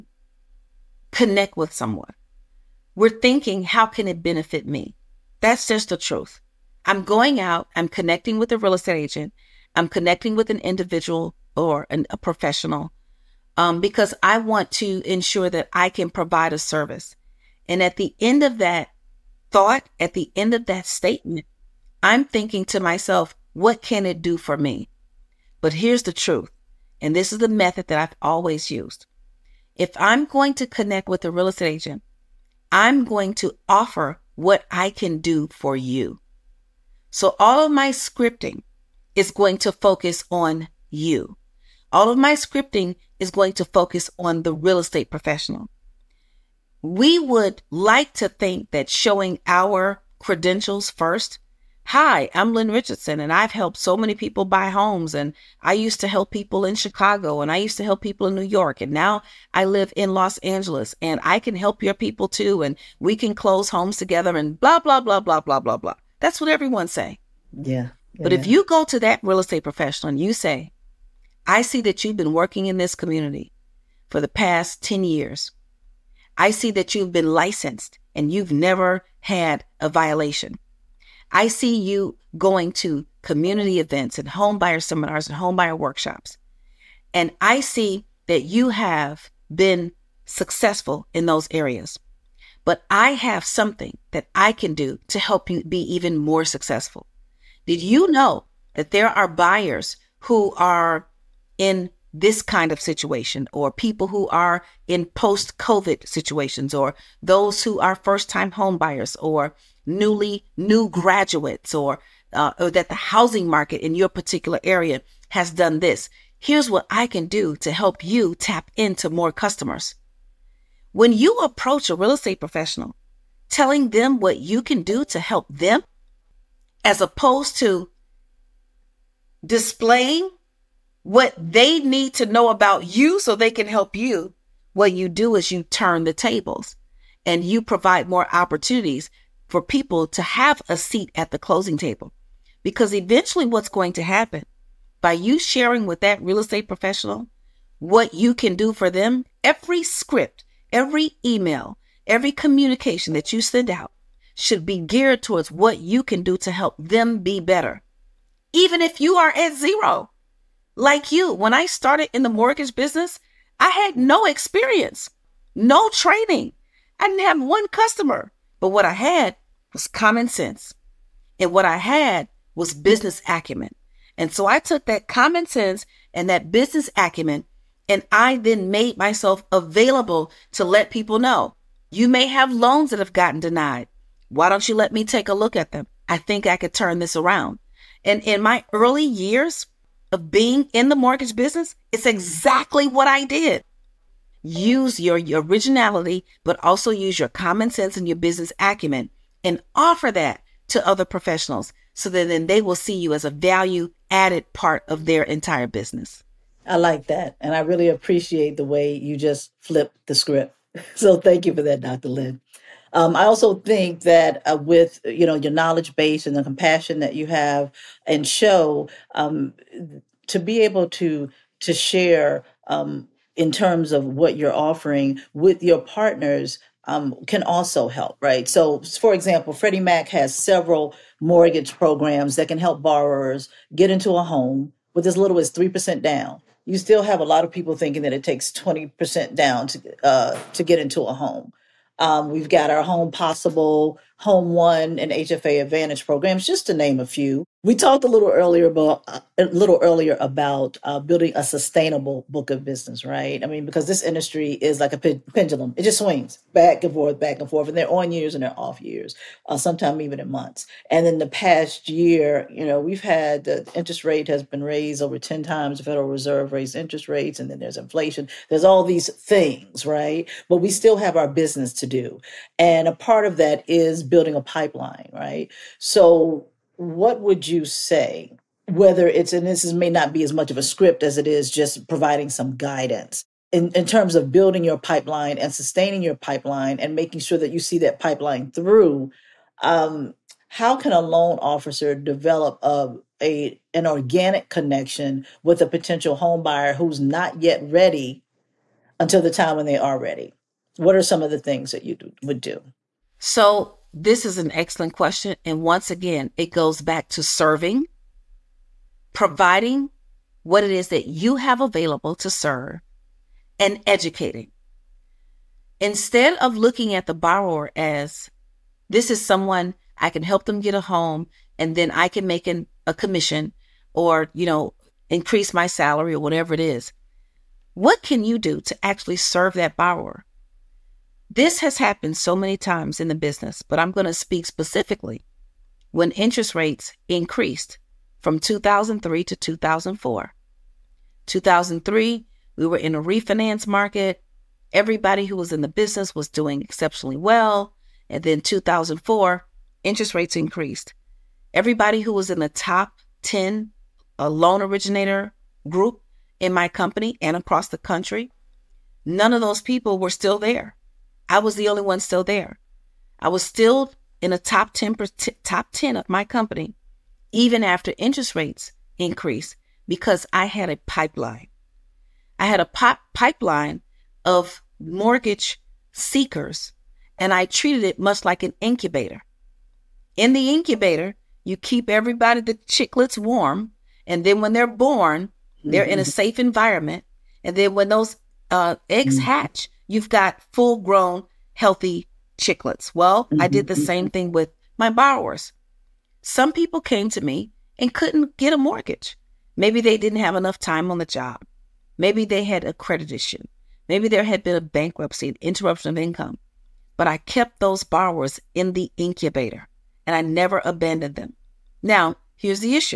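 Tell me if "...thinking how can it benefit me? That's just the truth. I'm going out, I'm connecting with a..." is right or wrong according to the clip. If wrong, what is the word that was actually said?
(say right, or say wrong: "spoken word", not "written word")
right.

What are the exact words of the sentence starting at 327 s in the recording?
What can you do to actually serve that borrower?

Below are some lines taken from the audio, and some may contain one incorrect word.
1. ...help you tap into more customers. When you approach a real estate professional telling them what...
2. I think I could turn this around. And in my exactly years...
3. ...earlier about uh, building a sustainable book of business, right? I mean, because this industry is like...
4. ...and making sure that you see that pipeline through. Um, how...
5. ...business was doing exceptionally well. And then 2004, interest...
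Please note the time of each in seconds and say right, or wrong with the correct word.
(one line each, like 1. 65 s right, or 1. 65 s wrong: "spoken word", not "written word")
1. 117 s right
2. 186 s wrong: "early", not "exactly"
3. 249 s right
4. 286 s right
5. 345 s right.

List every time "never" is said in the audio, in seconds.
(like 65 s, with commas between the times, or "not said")
78 s, 410 s.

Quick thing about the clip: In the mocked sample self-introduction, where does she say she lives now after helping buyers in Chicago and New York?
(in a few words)
Los Angeles.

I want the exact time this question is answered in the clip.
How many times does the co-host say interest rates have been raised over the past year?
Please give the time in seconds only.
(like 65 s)
265 s.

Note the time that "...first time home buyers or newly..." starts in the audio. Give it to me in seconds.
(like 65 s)
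107 s.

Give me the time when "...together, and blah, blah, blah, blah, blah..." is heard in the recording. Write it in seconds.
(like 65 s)
63 s.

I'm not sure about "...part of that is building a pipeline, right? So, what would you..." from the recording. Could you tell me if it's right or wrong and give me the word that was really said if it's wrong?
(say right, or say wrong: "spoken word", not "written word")
right.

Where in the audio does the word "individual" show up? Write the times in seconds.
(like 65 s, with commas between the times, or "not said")
10 s.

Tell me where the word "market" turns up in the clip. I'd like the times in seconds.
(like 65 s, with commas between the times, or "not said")
113 s, 343 s.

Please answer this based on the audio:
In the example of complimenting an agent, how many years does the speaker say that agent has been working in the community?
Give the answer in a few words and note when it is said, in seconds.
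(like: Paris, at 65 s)
10, at 74 s.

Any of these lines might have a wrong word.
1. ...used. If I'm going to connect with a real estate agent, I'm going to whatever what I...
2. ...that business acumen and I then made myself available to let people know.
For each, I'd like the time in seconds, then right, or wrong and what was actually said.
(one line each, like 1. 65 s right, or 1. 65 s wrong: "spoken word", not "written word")
1. 28 s wrong: "offer", not "whatever"
2. 176 s right.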